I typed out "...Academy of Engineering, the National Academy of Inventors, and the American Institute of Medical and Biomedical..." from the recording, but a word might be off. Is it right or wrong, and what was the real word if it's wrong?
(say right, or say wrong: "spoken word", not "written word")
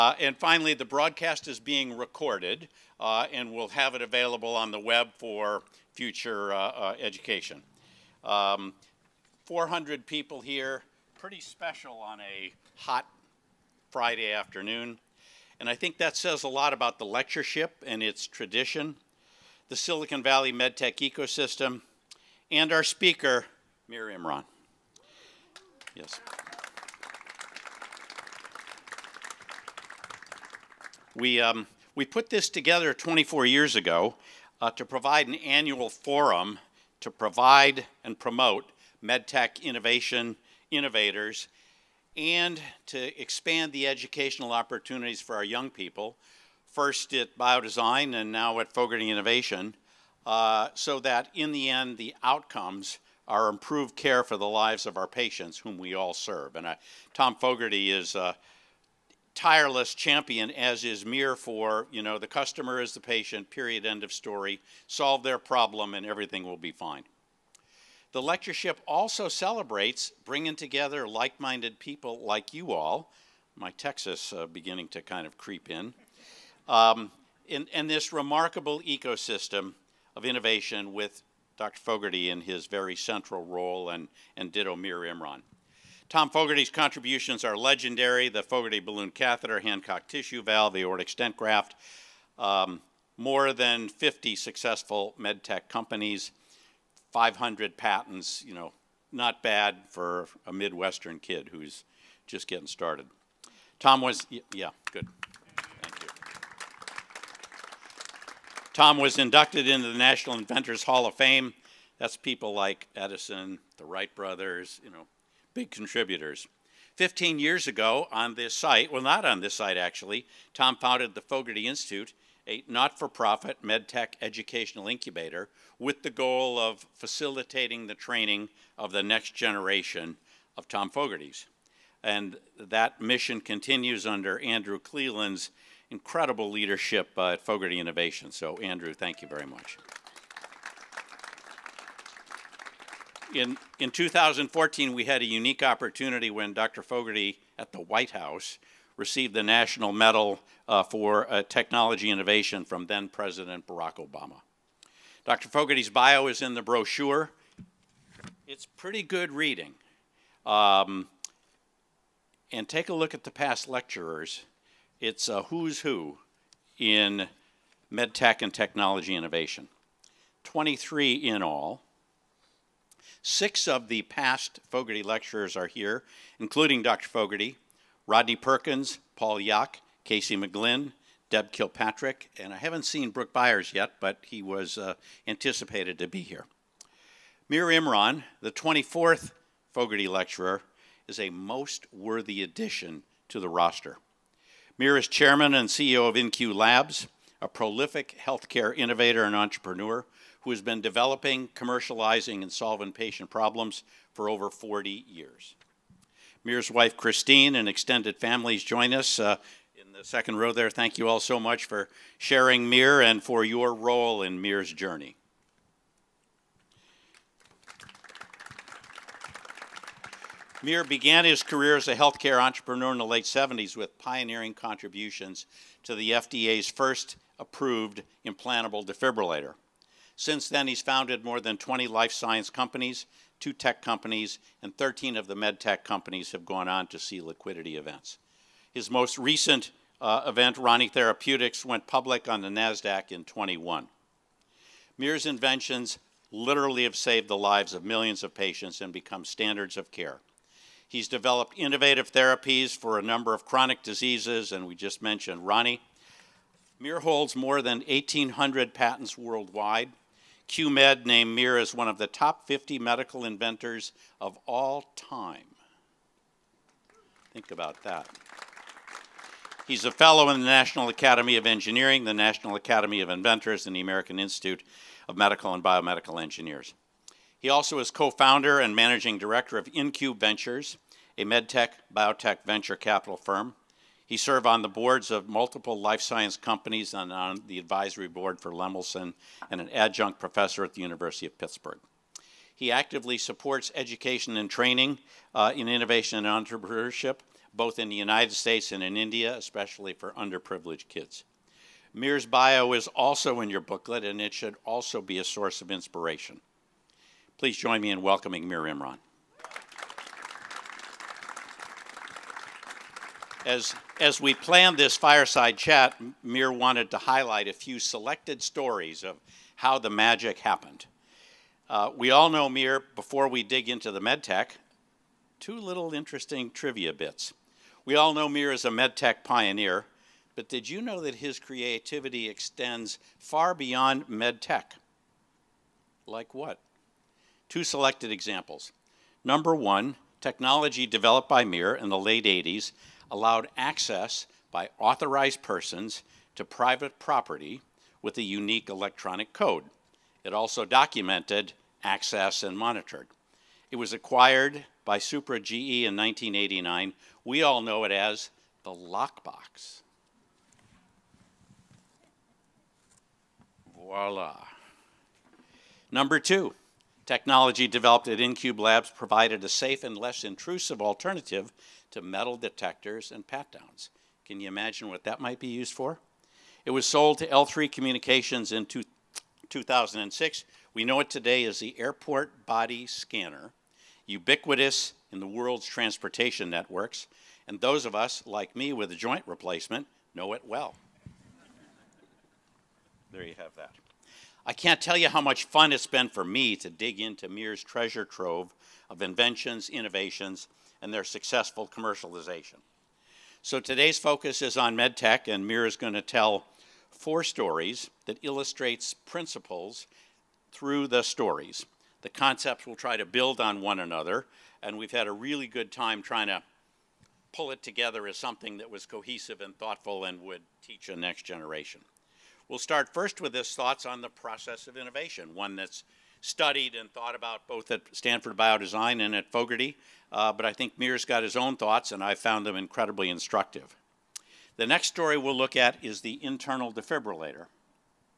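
right.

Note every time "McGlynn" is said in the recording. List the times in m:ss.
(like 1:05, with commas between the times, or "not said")
3:00.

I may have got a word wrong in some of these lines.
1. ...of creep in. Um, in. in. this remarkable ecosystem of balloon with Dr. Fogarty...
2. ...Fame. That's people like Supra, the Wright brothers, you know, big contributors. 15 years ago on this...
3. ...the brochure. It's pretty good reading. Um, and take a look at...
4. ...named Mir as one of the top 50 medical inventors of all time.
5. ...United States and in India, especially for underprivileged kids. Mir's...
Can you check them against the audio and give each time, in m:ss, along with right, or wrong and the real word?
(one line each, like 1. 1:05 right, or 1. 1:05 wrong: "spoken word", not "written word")
1. 1:15 wrong: "innovation", not "balloon"
2. 1:51 wrong: "Edison", not "Supra"
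3. 2:36 right
4. 4:21 right
5. 4:57 right.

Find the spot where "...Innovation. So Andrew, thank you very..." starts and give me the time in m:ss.
2:17.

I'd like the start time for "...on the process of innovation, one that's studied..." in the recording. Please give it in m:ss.
7:03.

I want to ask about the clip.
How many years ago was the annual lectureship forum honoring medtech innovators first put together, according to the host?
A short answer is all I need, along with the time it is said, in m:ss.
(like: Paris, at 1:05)
24, at 0:32.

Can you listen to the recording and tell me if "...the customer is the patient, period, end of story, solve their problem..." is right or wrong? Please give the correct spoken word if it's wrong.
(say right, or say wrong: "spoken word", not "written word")
right.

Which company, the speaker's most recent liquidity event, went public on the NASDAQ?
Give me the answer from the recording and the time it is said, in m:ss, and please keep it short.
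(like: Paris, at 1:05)
Rani Therapeutics, at 4:00.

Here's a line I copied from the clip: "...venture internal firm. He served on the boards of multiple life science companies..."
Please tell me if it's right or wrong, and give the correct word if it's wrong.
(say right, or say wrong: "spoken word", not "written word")
wrong: "capital", not "internal".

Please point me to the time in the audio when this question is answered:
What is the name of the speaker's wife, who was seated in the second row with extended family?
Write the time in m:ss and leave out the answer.
3:26.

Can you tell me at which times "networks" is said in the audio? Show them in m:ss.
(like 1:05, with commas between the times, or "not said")
6:26.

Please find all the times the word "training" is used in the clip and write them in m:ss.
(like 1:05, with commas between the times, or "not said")
2:07, 4:54.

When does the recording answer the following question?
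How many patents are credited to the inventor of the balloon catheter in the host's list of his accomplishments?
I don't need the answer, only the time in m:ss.
1:37.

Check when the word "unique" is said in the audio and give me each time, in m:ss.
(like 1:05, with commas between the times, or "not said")
2:25, 5:48.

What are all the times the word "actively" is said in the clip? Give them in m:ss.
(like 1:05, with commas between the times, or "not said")
4:52.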